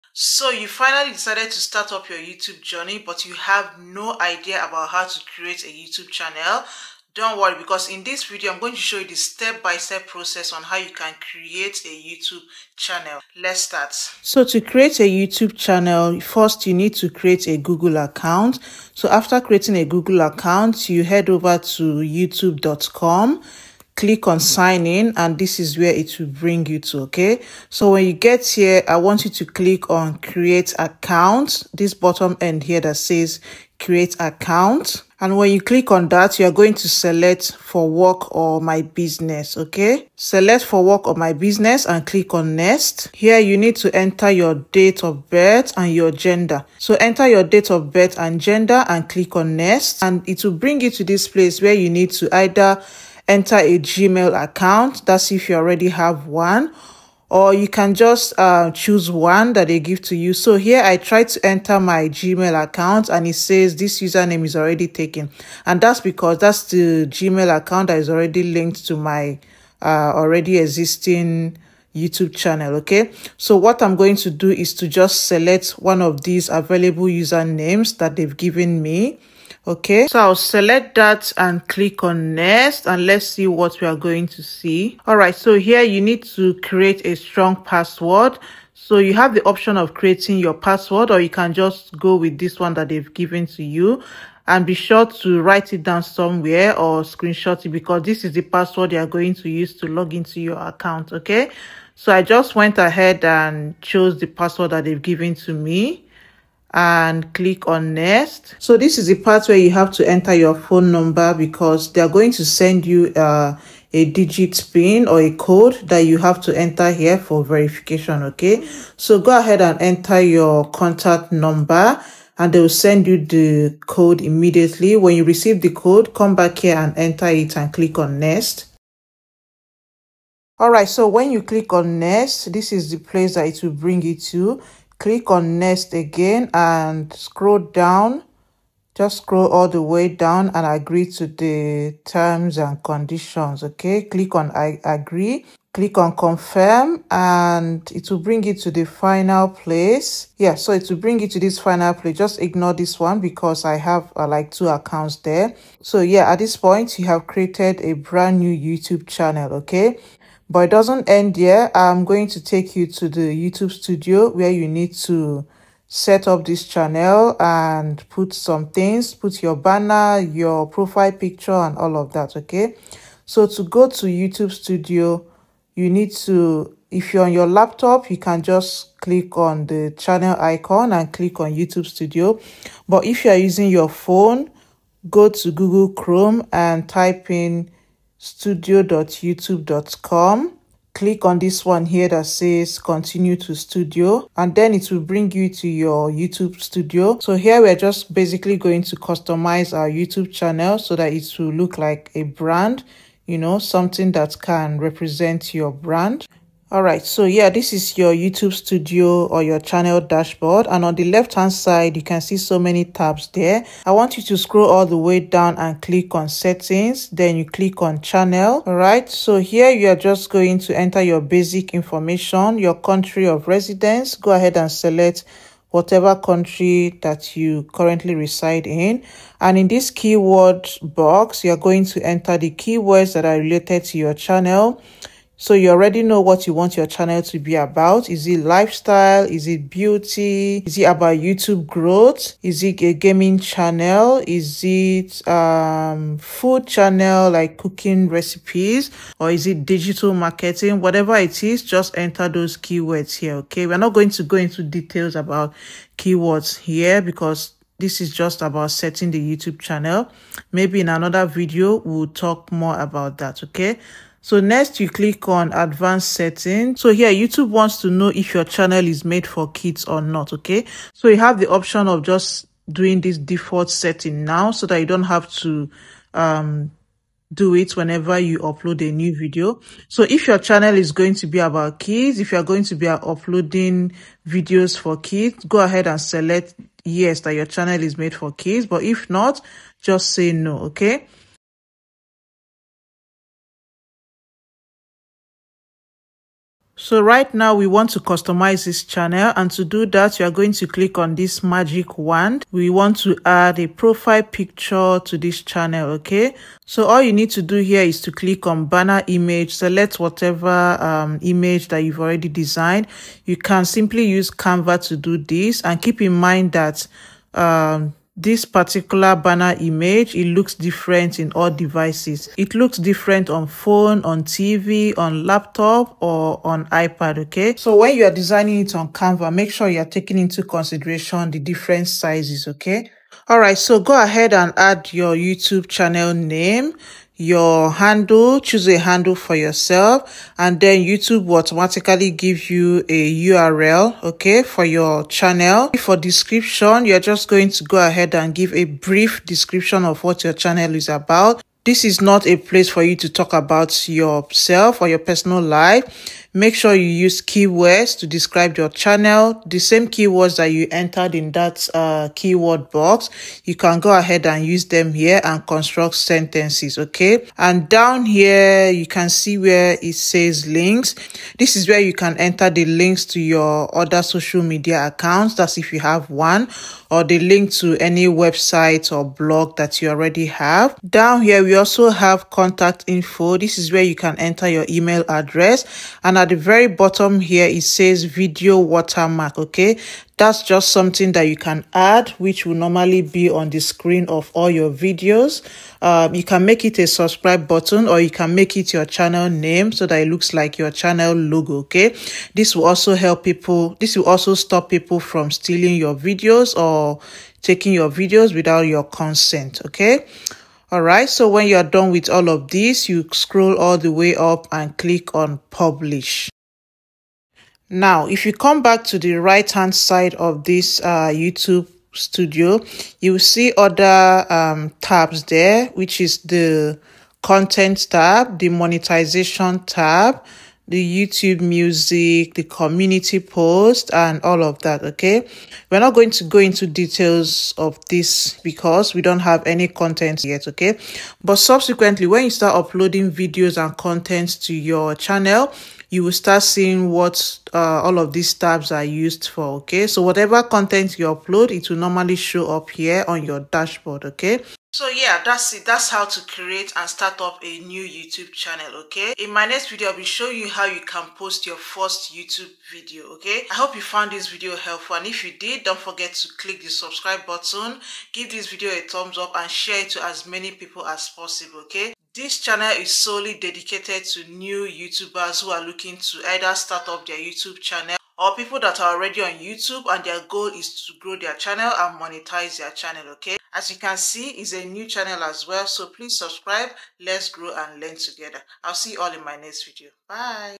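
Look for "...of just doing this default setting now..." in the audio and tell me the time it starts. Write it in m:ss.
4:31.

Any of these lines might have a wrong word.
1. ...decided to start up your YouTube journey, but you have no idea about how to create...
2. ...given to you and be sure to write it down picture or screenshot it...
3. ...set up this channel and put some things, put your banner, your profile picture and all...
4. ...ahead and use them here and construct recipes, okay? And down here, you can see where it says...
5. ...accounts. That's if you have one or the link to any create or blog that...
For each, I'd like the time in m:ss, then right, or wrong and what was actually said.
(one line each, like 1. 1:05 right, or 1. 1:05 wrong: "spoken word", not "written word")
1. 0:01 right
2. 1:33 wrong: "somewhere", not "picture"
3. 2:45 right
4. 6:03 wrong: "sentences", not "recipes"
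5. 6:14 wrong: "website", not "create".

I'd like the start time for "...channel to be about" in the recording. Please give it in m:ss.
3:56.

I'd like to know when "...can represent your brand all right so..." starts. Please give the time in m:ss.
3:24.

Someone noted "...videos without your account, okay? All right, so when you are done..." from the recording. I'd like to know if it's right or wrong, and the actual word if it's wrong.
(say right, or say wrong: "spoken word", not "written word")
wrong: "consent", not "account".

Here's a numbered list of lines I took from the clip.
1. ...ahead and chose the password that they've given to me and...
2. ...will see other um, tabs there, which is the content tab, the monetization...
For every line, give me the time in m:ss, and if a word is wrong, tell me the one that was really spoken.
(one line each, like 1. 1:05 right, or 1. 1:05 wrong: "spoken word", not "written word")
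1. 1:42 right
2. 7:03 right.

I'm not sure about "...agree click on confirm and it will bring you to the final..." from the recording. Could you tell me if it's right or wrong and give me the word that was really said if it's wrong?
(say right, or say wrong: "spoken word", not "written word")
right.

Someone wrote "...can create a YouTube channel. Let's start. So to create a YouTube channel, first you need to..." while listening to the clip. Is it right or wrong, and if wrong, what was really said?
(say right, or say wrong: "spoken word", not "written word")
right.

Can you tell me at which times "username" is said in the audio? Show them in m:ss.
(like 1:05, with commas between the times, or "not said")
1:04, 1:17.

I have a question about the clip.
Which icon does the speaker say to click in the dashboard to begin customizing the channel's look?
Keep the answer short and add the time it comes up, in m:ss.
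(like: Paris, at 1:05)
Magic wand, at 5:01.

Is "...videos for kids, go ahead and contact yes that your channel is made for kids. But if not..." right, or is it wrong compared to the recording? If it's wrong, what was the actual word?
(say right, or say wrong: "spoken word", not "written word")
wrong: "select", not "contact".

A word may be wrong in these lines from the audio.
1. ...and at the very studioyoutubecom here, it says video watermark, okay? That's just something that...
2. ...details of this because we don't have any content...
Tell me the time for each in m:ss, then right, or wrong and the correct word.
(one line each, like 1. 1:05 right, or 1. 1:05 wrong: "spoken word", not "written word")
1. 6:26 wrong: "bottom", not "studioyoutubecom"
2. 7:16 right.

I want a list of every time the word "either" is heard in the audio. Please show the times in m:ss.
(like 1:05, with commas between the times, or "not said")
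0:52, 7:56.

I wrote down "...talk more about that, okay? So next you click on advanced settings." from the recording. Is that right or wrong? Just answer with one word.
right.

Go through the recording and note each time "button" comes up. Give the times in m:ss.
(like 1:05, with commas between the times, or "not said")
6:37, 7:47.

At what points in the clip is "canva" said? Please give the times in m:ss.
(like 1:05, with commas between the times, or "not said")
5:14, 5:28.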